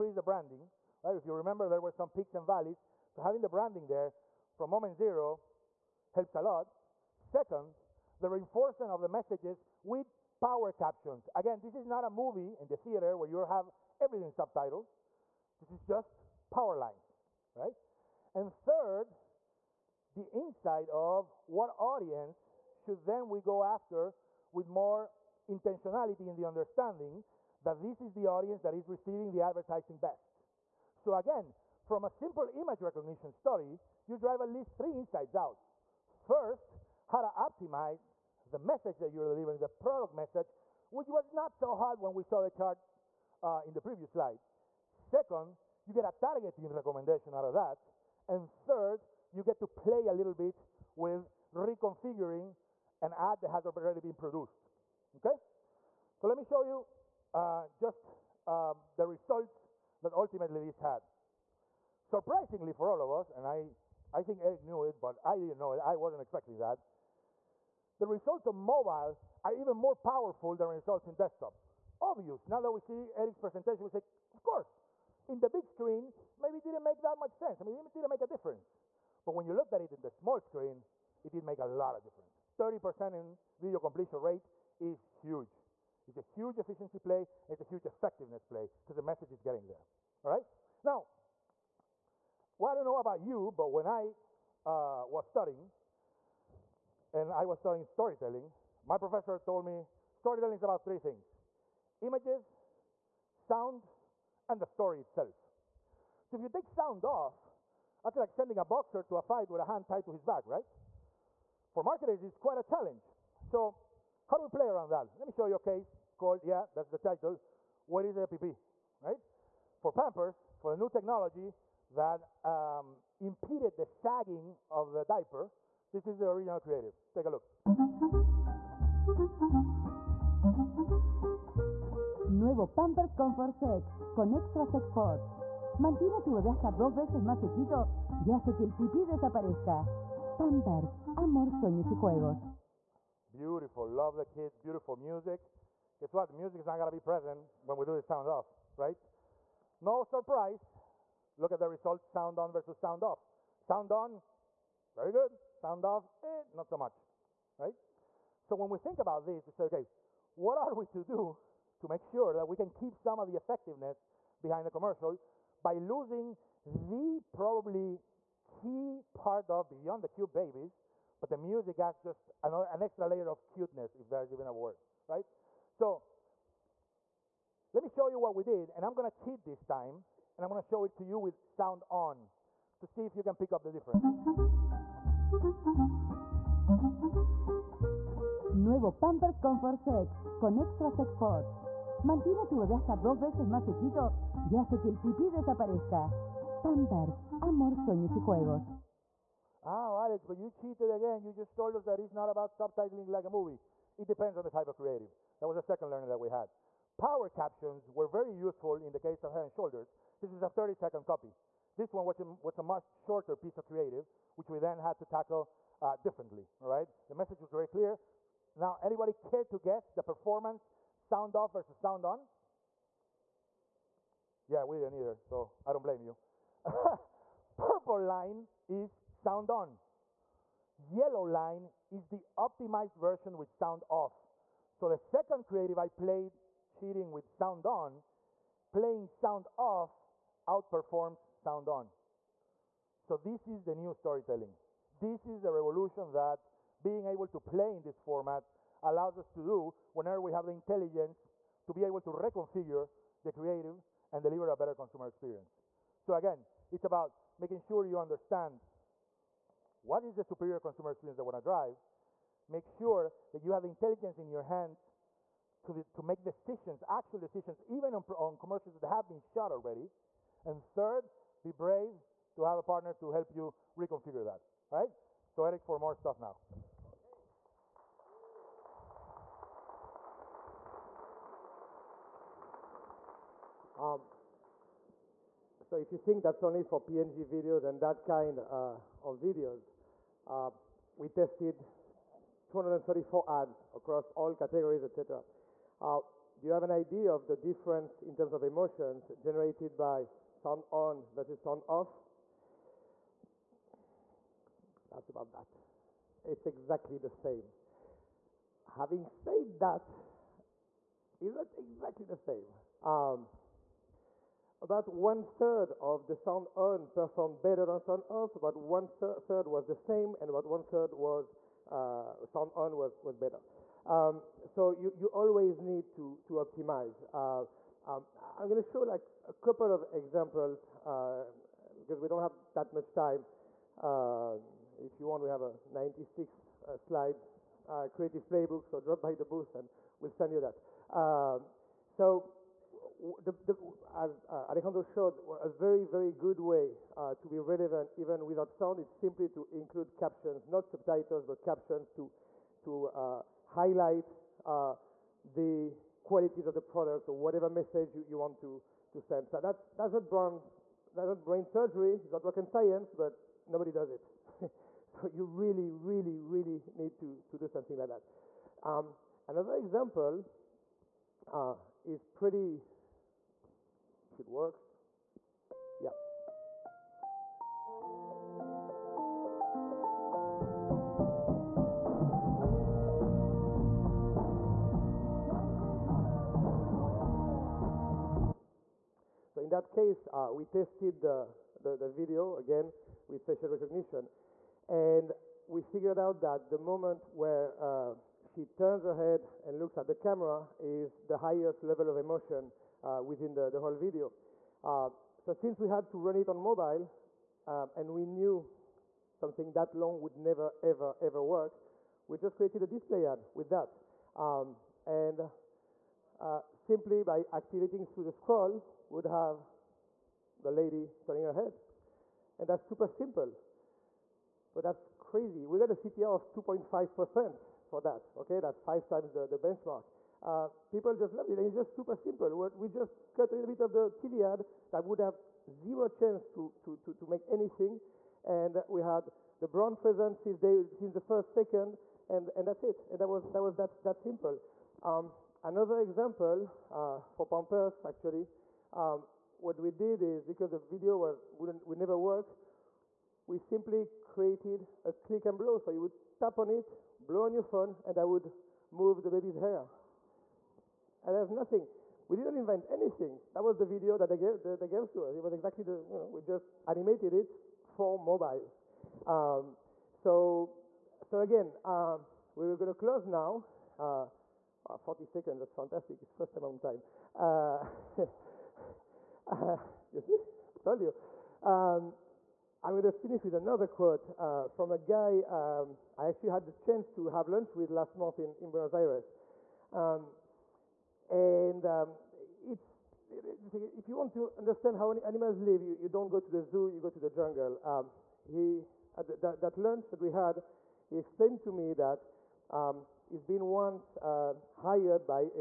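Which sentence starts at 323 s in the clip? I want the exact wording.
Um, so you, you always need to, to optimize.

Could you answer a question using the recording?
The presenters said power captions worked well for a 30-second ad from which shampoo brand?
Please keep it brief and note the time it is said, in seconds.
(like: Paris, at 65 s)
Head and Shoulders, at 209 s.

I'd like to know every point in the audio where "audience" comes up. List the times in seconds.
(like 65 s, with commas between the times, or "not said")
21 s, 28 s.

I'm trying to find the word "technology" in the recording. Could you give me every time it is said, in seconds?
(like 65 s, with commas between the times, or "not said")
120 s.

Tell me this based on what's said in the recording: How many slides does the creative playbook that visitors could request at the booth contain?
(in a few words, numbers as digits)
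96.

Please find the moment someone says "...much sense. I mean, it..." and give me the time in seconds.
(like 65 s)
77 s.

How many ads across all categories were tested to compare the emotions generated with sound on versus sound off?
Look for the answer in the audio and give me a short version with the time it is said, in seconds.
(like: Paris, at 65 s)
234, at 292 s.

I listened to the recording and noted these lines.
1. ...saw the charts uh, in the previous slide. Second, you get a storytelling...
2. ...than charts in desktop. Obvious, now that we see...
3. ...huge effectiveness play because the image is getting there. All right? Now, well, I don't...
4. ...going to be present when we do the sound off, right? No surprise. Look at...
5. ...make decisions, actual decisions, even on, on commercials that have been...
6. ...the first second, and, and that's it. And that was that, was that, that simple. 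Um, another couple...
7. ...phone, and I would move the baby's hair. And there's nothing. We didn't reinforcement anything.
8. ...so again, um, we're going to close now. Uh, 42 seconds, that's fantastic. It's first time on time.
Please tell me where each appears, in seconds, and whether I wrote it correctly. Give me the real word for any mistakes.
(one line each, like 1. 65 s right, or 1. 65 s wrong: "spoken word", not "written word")
1. 42 s wrong: "targeting", not "storytelling"
2. 70 s wrong: "results", not "charts"
3. 87 s wrong: "message", not "image"
4. 146 s right
5. 266 s right
6. 440 s wrong: "example", not "couple"
7. 457 s wrong: "invent", not "reinforcement"
8. 471 s wrong: "40", not "42".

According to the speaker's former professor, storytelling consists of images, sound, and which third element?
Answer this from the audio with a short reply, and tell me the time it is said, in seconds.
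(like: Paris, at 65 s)
The story itself, at 104 s.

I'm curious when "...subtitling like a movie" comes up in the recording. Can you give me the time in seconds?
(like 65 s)
202 s.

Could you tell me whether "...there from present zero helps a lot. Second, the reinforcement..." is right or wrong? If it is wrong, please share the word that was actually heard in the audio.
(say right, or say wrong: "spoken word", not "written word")
wrong: "moment", not "present".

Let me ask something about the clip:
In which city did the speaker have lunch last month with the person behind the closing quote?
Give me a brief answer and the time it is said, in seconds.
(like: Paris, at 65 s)
Buenos Aires, at 488 s.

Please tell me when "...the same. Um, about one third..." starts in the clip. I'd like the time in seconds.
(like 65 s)
312 s.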